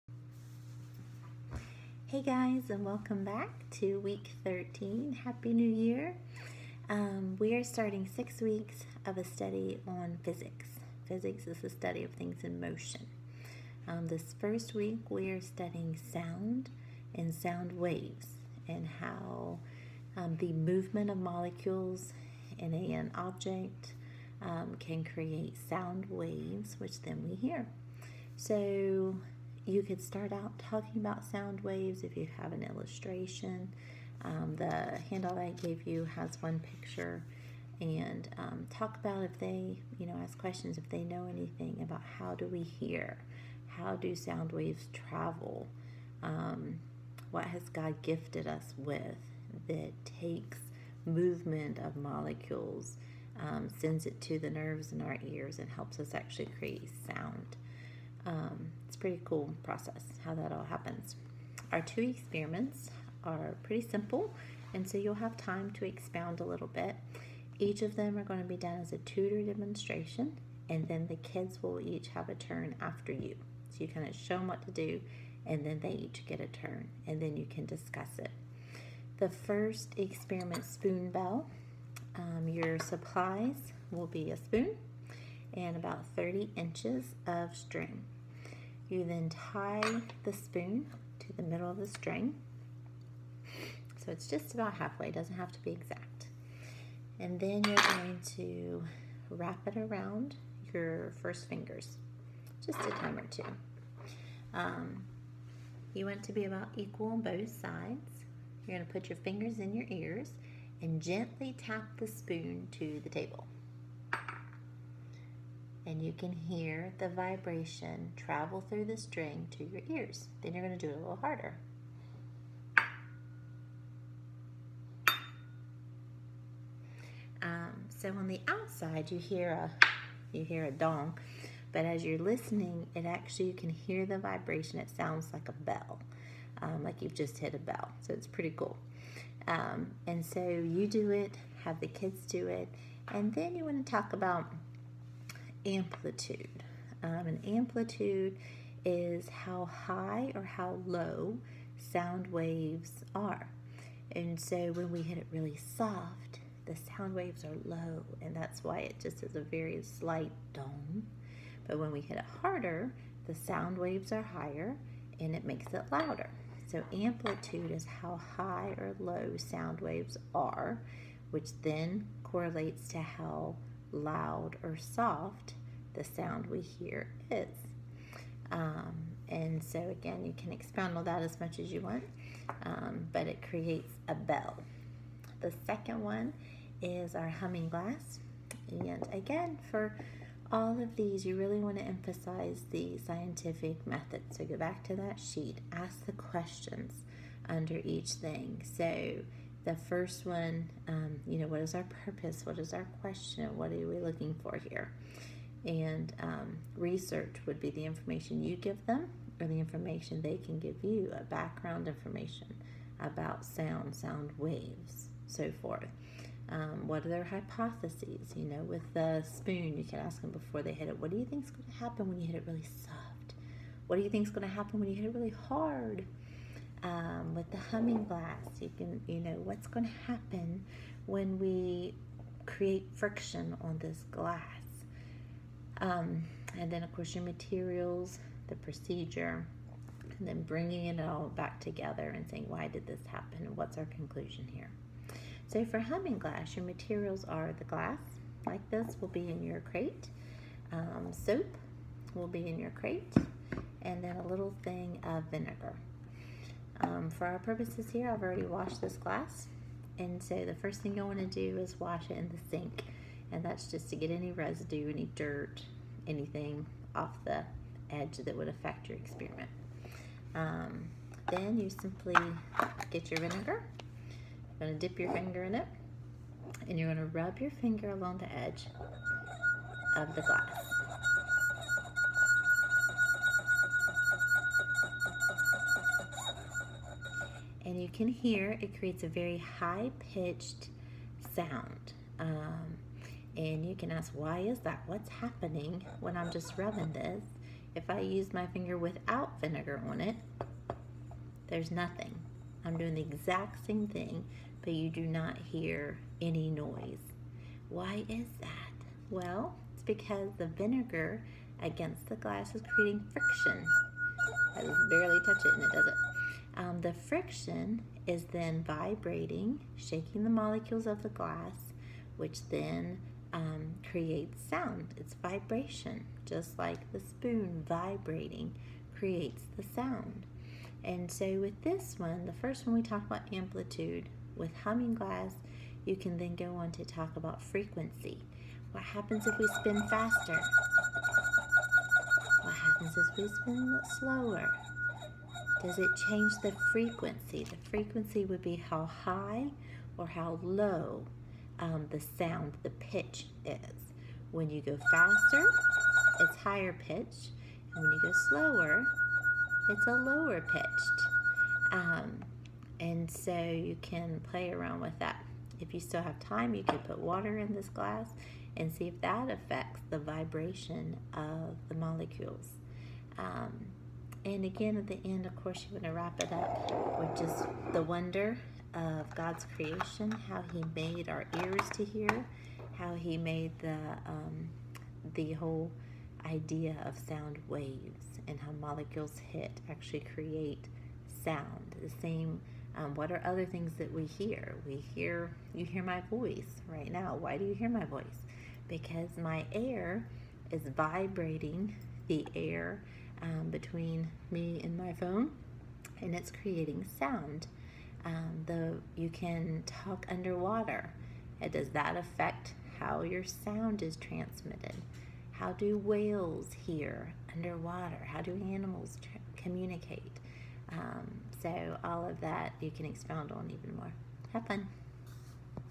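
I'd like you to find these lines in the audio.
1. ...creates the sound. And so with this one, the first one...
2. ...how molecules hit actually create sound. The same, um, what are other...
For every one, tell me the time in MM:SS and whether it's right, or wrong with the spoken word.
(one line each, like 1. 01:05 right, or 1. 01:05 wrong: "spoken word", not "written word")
1. 05:28 right
2. 06:28 right.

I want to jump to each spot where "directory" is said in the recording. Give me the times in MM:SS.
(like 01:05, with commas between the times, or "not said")
not said.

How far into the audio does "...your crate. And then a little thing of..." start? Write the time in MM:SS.
04:12.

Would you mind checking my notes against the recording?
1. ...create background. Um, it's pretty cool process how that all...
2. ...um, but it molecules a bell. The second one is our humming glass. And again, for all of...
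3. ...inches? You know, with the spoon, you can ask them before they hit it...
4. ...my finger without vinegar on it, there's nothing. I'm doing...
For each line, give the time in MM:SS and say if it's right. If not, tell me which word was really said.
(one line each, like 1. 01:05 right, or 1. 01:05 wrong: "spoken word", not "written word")
1. 00:56 wrong: "sound", not "background"
2. 03:02 wrong: "creates", not "molecules"
3. 03:37 wrong: "hypotheses", not "inches"
4. 04:58 right.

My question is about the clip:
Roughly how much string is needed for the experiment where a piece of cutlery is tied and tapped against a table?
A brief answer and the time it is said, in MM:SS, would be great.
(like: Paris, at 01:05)
30 inches, at 01:25.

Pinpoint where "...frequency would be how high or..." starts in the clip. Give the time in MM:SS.
05:47.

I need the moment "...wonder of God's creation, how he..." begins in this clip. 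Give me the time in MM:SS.
06:17.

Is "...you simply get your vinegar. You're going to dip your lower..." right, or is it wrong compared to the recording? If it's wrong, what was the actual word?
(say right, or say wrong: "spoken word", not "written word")
wrong: "finger", not "lower".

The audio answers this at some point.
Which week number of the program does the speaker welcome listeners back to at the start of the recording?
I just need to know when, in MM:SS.
00:04.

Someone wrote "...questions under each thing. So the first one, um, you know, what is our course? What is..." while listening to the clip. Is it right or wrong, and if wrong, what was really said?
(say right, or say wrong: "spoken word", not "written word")
wrong: "purpose", not "course".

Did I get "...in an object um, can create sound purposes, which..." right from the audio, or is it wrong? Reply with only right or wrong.
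wrong.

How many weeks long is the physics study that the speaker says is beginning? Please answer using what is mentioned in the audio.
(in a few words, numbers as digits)
6.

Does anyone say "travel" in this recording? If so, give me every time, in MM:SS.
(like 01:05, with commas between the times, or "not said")
00:44, 01:58.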